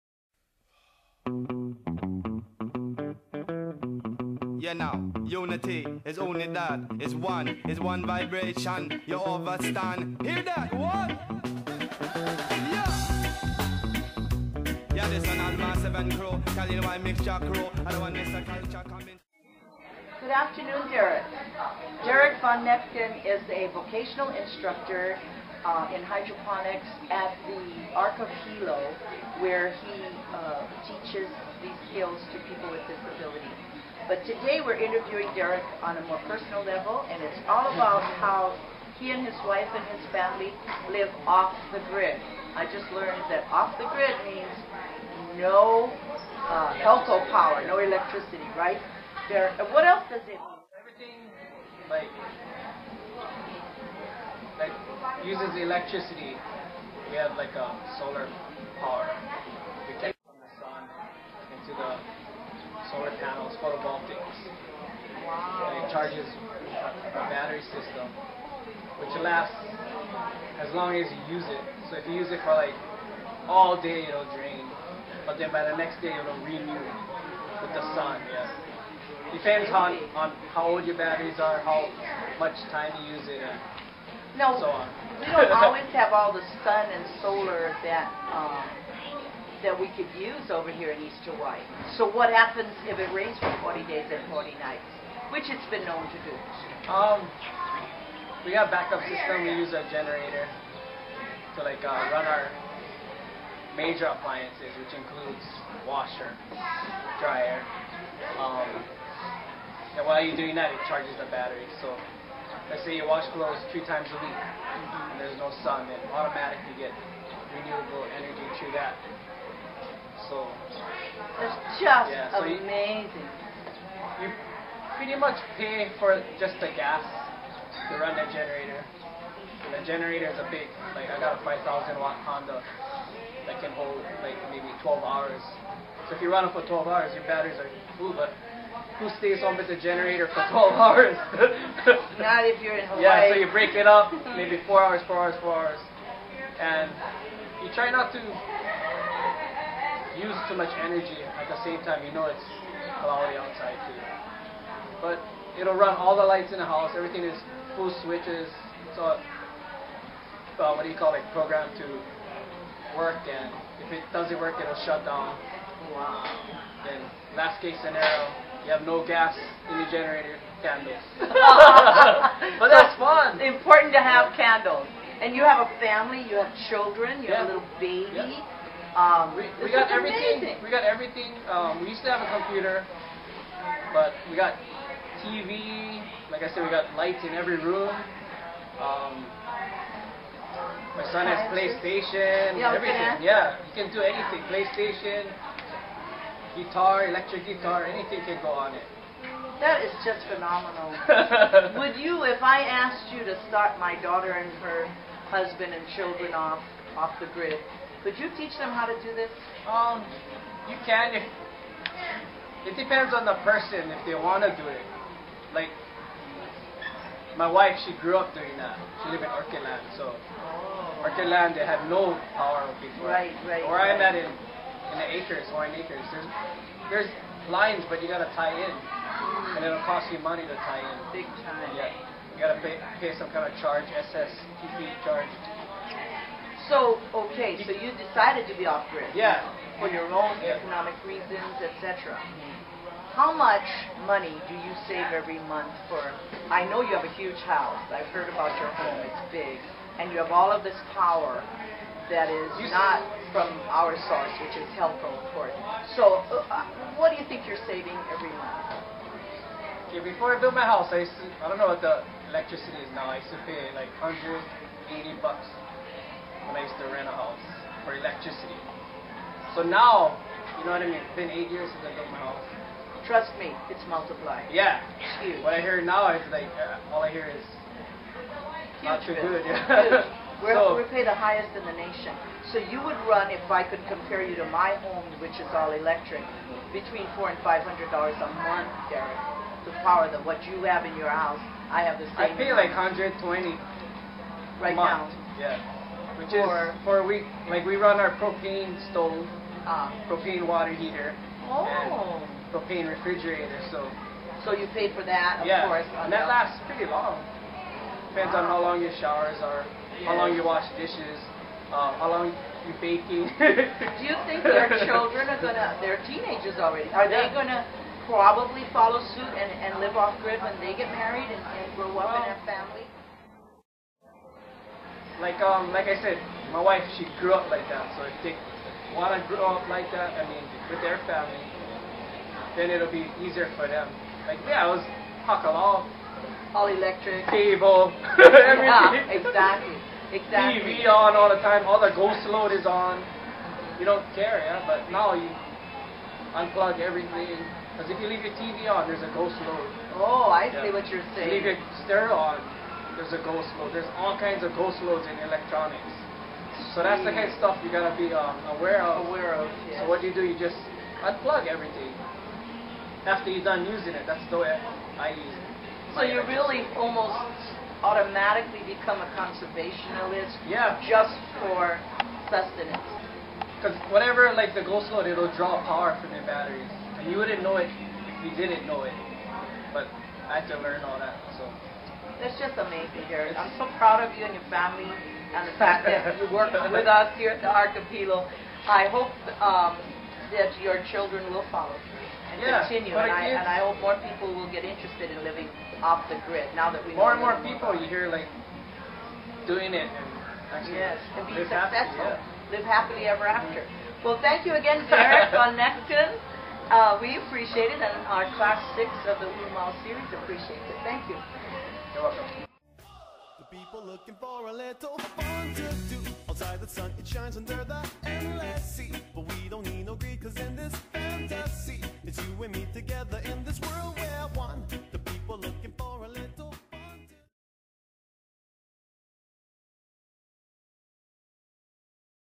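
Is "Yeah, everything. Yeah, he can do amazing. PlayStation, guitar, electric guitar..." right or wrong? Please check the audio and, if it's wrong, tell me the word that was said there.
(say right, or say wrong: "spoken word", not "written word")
wrong: "anything", not "amazing".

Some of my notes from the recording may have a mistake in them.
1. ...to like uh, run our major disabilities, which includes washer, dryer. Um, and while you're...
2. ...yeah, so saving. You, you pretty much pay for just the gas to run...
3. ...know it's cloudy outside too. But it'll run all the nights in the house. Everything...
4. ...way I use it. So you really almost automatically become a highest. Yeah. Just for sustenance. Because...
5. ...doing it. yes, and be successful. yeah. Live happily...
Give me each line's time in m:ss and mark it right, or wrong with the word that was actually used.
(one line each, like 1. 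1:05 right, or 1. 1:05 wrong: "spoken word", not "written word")
1. 1:41 wrong: "appliances", not "disabilities"
2. 2:02 wrong: "amazing", not "saving"
3. 2:32 wrong: "lights", not "nights"
4. 6:04 wrong: "conservationist", not "highest"
5. 6:39 right.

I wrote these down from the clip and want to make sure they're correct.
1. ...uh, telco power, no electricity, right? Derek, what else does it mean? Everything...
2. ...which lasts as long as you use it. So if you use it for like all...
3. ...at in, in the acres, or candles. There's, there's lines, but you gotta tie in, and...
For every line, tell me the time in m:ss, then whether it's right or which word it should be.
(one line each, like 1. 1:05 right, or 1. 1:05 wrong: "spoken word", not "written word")
1. 0:46 right
2. 1:08 right
3. 3:44 wrong: "acres", not "candles".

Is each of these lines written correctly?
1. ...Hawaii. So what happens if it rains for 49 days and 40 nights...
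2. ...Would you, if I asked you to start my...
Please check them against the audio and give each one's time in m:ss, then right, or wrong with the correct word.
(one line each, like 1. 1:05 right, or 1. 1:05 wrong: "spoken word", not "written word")
1. 1:31 wrong: "40", not "49"
2. 3:21 right.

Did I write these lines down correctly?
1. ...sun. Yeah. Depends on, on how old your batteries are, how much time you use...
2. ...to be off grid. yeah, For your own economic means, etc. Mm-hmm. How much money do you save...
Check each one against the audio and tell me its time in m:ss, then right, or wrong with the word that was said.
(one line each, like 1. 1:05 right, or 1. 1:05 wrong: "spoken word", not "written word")
1. 1:17 right
2. 3:58 wrong: "reasons", not "means".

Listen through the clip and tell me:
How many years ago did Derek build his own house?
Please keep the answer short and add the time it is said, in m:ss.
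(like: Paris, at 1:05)
8, at 4:31.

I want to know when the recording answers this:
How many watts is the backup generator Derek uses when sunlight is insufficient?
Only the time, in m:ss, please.
2:11.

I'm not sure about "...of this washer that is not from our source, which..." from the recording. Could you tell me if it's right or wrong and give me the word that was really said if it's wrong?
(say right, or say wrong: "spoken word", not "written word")
wrong: "power", not "washer".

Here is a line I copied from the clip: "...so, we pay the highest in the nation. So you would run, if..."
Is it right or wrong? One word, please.
right.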